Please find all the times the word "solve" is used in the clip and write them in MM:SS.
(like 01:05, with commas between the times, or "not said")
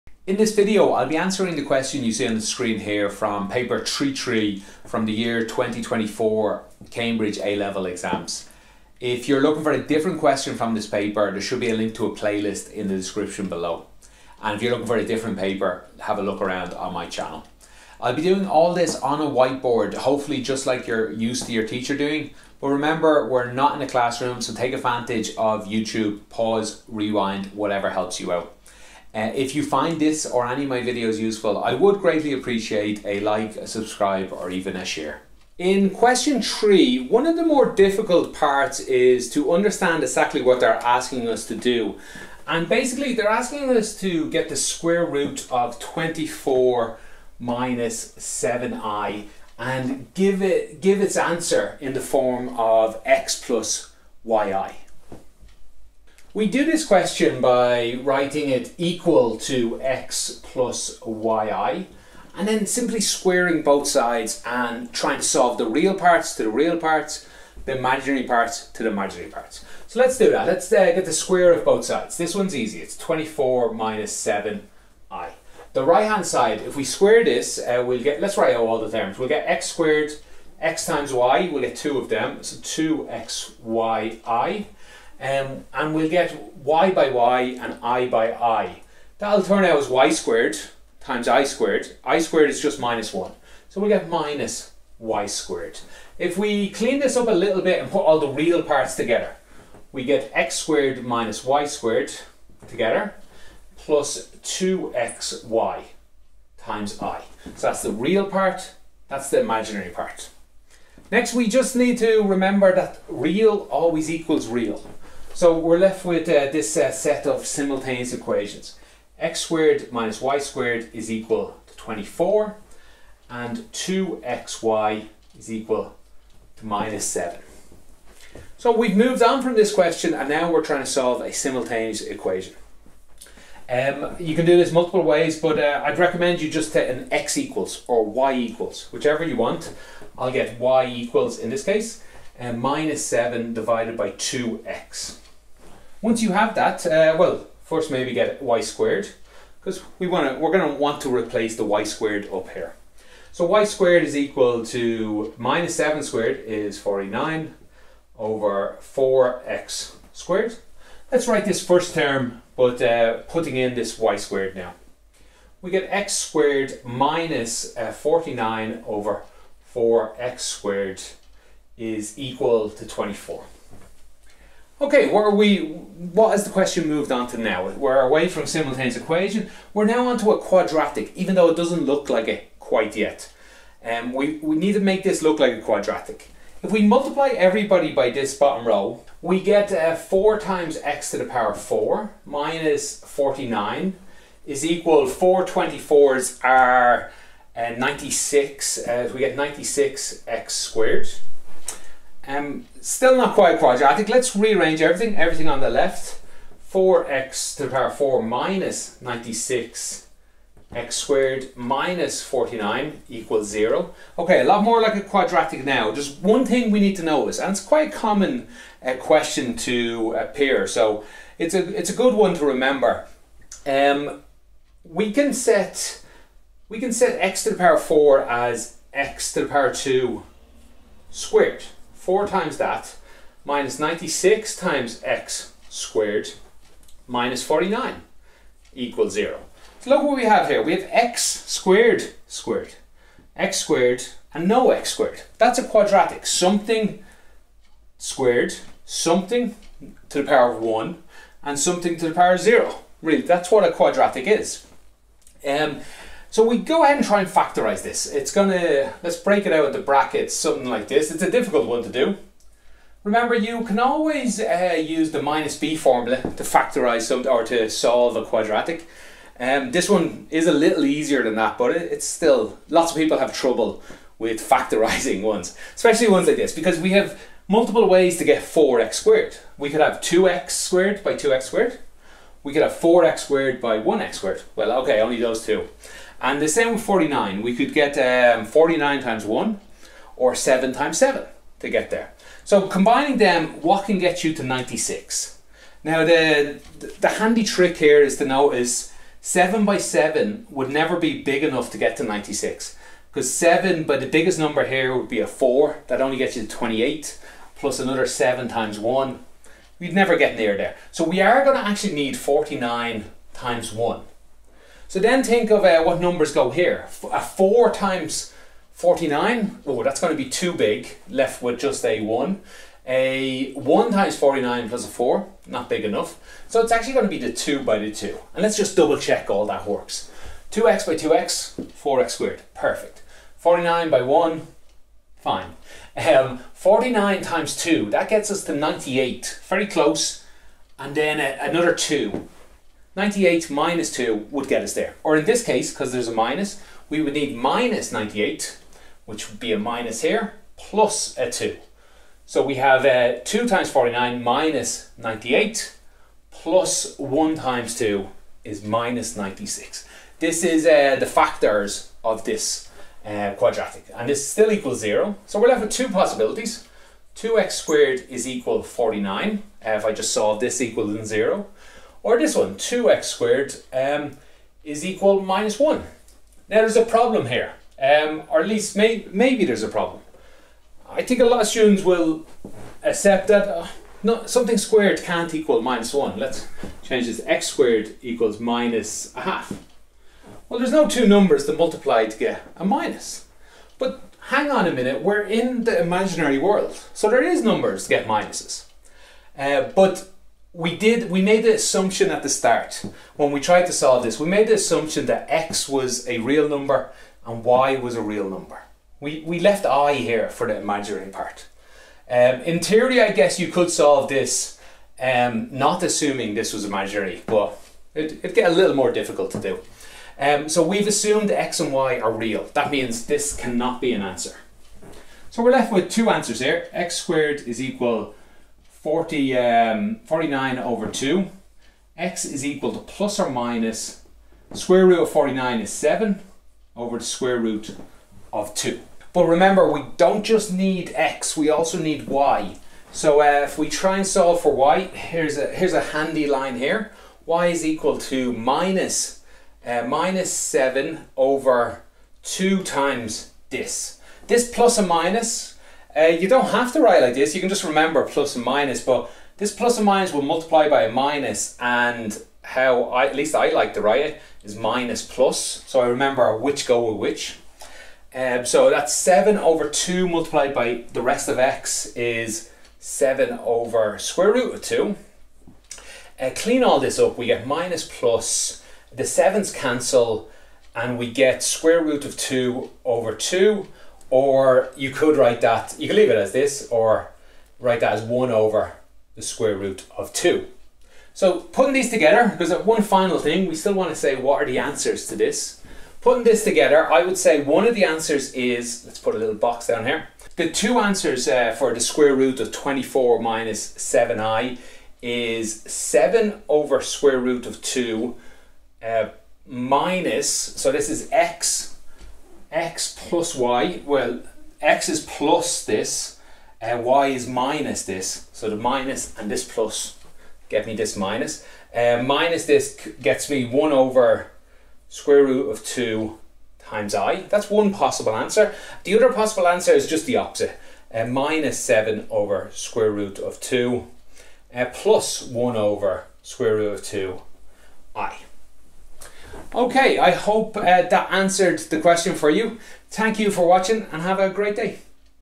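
01:05, 02:10, 04:27, 06:10, 06:43, 06:53, 07:24.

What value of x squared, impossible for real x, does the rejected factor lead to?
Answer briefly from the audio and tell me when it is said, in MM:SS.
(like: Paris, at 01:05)
minus a half, at 06:28.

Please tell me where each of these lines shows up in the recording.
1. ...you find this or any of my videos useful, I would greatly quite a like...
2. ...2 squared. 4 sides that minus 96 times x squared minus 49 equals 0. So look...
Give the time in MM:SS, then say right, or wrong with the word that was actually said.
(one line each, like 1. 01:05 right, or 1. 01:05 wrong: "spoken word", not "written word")
1. 00:29 wrong: "appreciate", not "quite"
2. 03:49 wrong: "times", not "sides".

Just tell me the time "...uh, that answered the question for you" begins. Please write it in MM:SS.
09:00.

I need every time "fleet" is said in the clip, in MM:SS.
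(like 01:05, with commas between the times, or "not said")
not said.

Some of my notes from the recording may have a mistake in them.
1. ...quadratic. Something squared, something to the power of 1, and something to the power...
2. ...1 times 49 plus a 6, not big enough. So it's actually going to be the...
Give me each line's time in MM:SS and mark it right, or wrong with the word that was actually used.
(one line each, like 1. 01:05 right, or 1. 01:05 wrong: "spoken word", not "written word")
1. 04:05 right
2. 05:23 wrong: "4", not "6".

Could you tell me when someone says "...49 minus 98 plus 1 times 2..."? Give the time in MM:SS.
05:53.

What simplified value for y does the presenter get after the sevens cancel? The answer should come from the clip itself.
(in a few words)
square root of 2 over 2.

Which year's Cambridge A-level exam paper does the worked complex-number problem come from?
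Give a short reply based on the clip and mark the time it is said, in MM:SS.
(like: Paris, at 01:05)
2024, at 00:05.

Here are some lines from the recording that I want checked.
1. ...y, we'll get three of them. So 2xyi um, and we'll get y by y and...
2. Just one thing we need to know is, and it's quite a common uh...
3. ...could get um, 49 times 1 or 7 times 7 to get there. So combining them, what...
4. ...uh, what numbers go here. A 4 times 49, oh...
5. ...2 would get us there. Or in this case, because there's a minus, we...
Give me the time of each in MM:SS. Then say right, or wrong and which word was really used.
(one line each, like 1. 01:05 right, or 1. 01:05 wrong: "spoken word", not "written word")
1. 01:21 wrong: "two", not "three"
2. 03:35 right
3. 04:47 right
4. 05:15 right
5. 05:43 right.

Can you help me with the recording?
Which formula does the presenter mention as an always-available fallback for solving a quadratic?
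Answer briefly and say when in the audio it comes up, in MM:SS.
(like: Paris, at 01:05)
the minus b formula, at 04:25.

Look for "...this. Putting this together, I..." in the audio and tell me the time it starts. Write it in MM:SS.
08:15.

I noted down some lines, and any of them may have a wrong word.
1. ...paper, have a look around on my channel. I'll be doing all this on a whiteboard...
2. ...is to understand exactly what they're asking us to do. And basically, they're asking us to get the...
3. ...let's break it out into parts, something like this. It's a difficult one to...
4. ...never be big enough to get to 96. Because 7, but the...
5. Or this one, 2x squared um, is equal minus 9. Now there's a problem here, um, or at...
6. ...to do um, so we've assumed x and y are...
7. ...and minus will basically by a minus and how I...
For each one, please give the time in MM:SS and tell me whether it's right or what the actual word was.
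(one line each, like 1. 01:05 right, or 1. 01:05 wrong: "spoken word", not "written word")
1. 00:15 right
2. 00:38 right
3. 04:19 wrong: "brackets", not "parts"
4. 05:00 right
5. 06:12 wrong: "1", not "9"
6. 06:59 right
7. 07:39 wrong: "multiply", not "basically".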